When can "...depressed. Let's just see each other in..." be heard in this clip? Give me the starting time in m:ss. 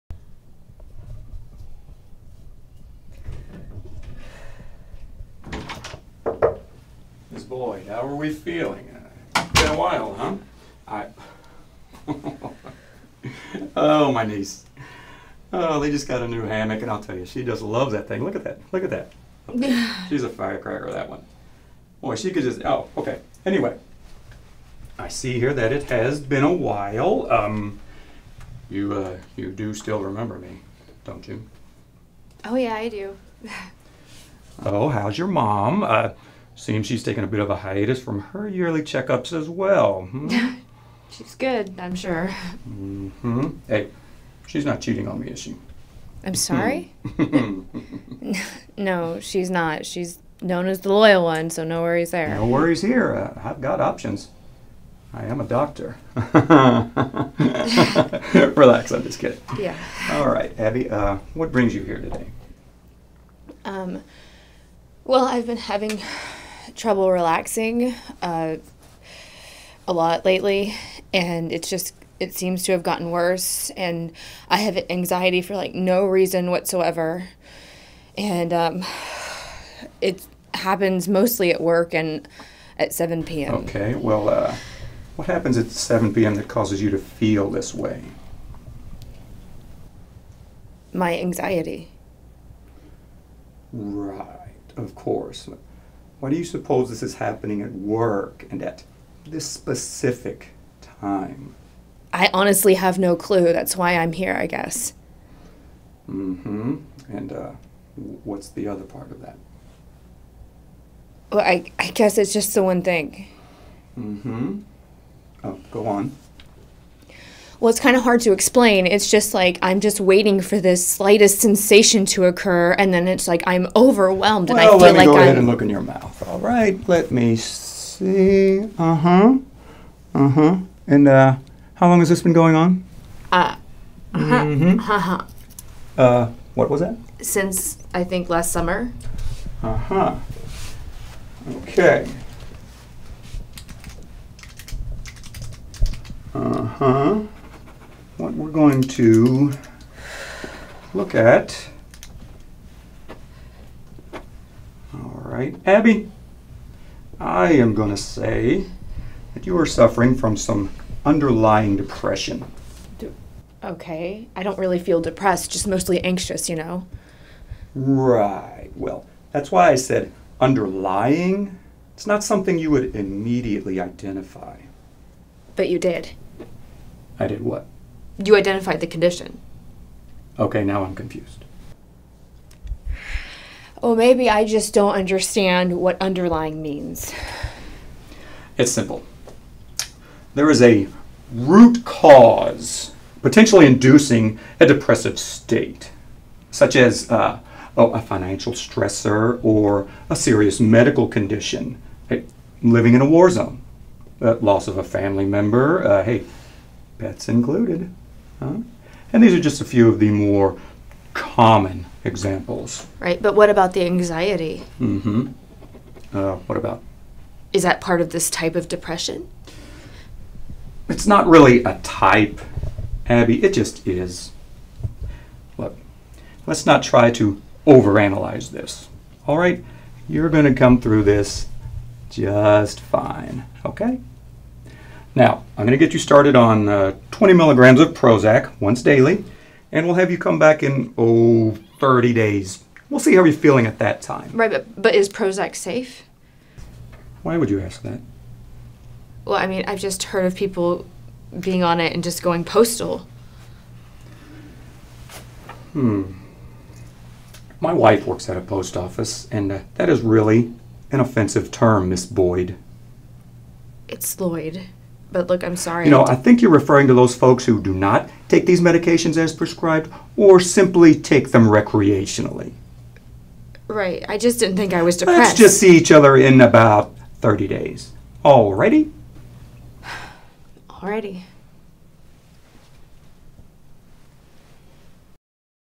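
4:34.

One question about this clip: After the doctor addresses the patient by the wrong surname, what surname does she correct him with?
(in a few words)
Lloyd.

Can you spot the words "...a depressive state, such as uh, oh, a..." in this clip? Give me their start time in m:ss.
3:14.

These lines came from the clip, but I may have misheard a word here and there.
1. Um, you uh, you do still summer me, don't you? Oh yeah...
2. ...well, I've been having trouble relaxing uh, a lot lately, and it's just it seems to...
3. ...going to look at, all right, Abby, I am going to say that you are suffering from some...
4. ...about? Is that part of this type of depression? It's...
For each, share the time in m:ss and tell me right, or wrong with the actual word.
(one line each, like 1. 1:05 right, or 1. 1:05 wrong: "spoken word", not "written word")
1. 0:27 wrong: "remember", not "summer"
2. 1:05 right
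3. 2:28 right
4. 3:36 right.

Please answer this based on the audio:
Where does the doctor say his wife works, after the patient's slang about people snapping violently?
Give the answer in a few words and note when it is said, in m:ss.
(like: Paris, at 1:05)
post office, at 4:18.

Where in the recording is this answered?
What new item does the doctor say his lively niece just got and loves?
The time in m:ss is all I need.
0:16.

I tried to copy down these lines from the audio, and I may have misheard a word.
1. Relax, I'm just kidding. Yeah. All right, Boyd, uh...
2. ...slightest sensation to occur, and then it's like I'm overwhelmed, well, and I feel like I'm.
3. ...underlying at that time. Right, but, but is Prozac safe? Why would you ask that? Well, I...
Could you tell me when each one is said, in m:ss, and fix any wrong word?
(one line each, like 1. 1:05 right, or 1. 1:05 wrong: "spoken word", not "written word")
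1. 0:58 wrong: "Abby", not "Boyd"
2. 2:00 right
3. 4:03 wrong: "feeling", not "underlying".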